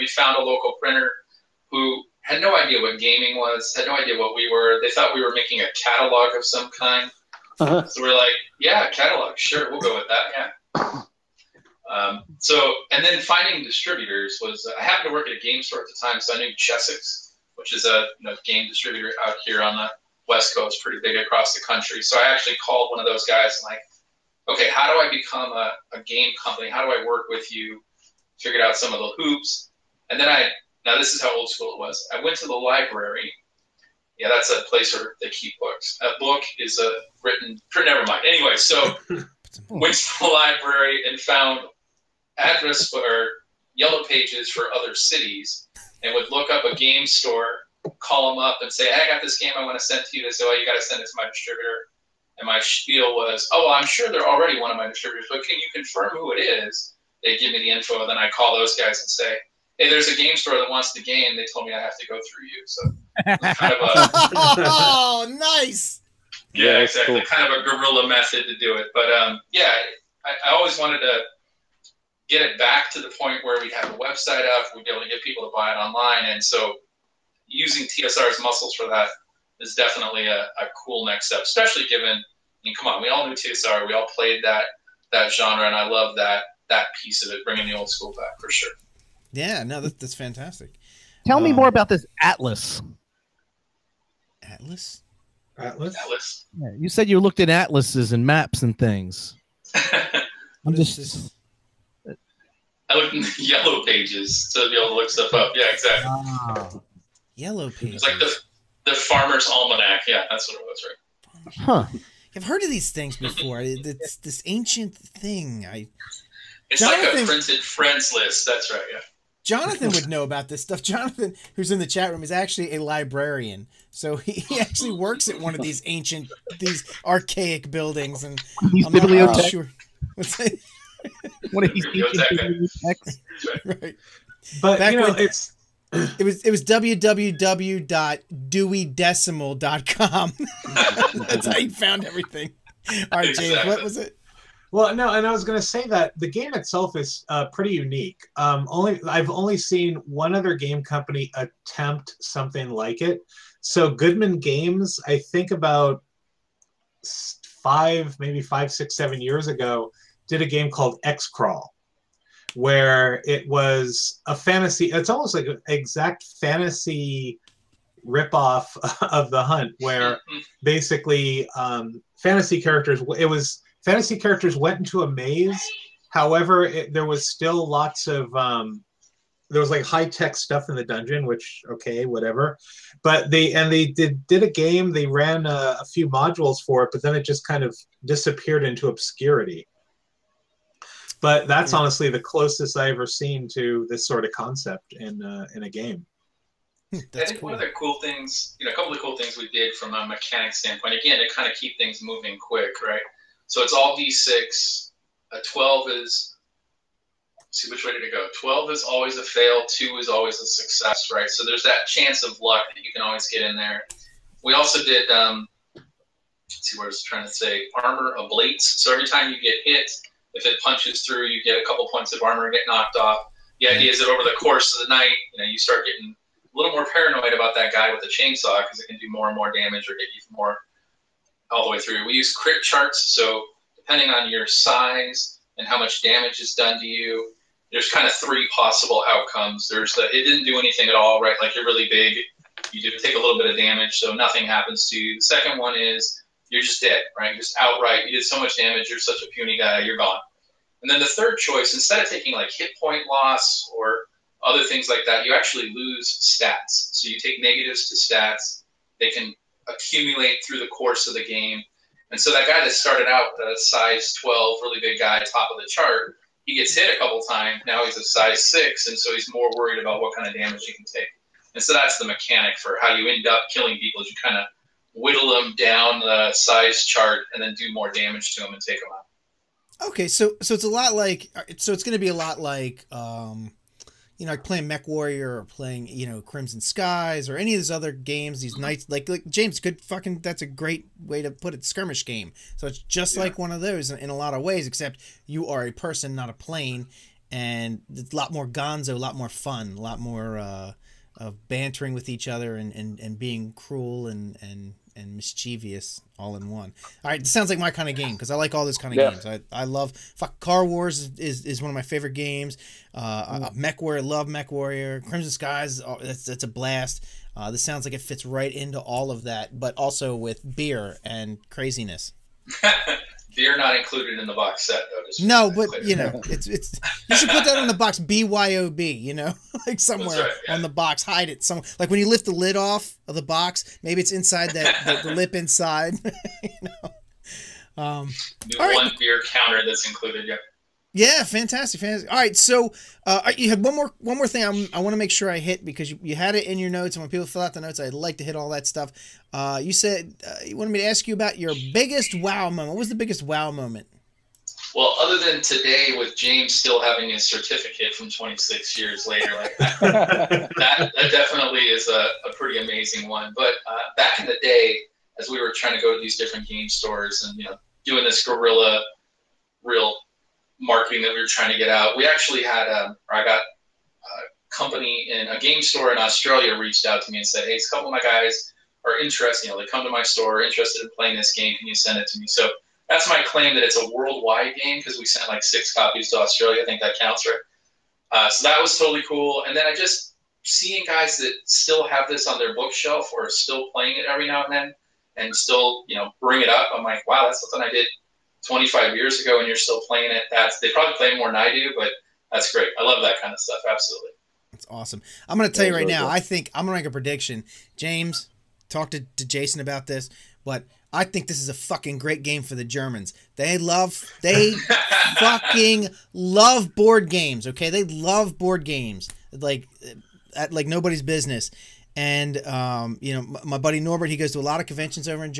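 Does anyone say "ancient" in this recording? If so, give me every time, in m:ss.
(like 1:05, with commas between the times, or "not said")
1:54, 2:05.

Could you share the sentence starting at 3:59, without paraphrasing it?
There's the it didn't do anything at all, right?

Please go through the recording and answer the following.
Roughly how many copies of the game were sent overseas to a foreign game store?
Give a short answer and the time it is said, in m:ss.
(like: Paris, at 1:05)
6, at 6:25.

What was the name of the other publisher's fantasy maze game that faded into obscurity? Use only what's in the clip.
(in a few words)
Xcrawl.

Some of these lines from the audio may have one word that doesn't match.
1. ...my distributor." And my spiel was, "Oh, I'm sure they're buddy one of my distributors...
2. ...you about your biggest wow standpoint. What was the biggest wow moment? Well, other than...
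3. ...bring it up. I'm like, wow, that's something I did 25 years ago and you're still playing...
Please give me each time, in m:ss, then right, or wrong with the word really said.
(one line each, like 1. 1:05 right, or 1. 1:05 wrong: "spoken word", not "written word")
1. 0:51 wrong: "already", not "buddy"
2. 5:51 wrong: "moment", not "standpoint"
3. 6:36 right.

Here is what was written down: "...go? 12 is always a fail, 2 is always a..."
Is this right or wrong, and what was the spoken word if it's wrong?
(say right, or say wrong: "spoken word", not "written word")
right.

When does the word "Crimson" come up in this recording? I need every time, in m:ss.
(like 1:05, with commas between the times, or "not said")
4:46, 5:15.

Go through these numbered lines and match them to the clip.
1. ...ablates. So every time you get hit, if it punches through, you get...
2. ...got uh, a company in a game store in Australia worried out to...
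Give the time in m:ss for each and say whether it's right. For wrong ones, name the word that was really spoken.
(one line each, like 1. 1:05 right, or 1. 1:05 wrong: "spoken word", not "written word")
1. 3:38 right
2. 6:13 wrong: "reached", not "worried".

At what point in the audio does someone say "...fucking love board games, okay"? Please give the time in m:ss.
6:55.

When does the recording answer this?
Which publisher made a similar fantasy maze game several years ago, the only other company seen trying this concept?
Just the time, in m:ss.
2:33.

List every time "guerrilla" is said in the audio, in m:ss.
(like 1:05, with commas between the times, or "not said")
1:07, 6:08.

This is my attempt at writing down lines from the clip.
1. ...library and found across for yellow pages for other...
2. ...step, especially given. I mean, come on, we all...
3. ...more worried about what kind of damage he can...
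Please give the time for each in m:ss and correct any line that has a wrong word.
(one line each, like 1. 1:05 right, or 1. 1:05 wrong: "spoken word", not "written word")
1. 0:40 wrong: "address", not "across"
2. 1:21 right
3. 4:29 right.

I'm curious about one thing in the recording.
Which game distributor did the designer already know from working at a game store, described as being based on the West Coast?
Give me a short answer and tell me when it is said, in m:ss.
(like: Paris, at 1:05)
Chessex, at 0:16.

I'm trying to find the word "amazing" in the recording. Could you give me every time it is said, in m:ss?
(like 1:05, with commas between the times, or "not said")
6:02.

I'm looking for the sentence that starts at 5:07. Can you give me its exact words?
All right, this sounds like my kind of game because I like all this kind of yeah.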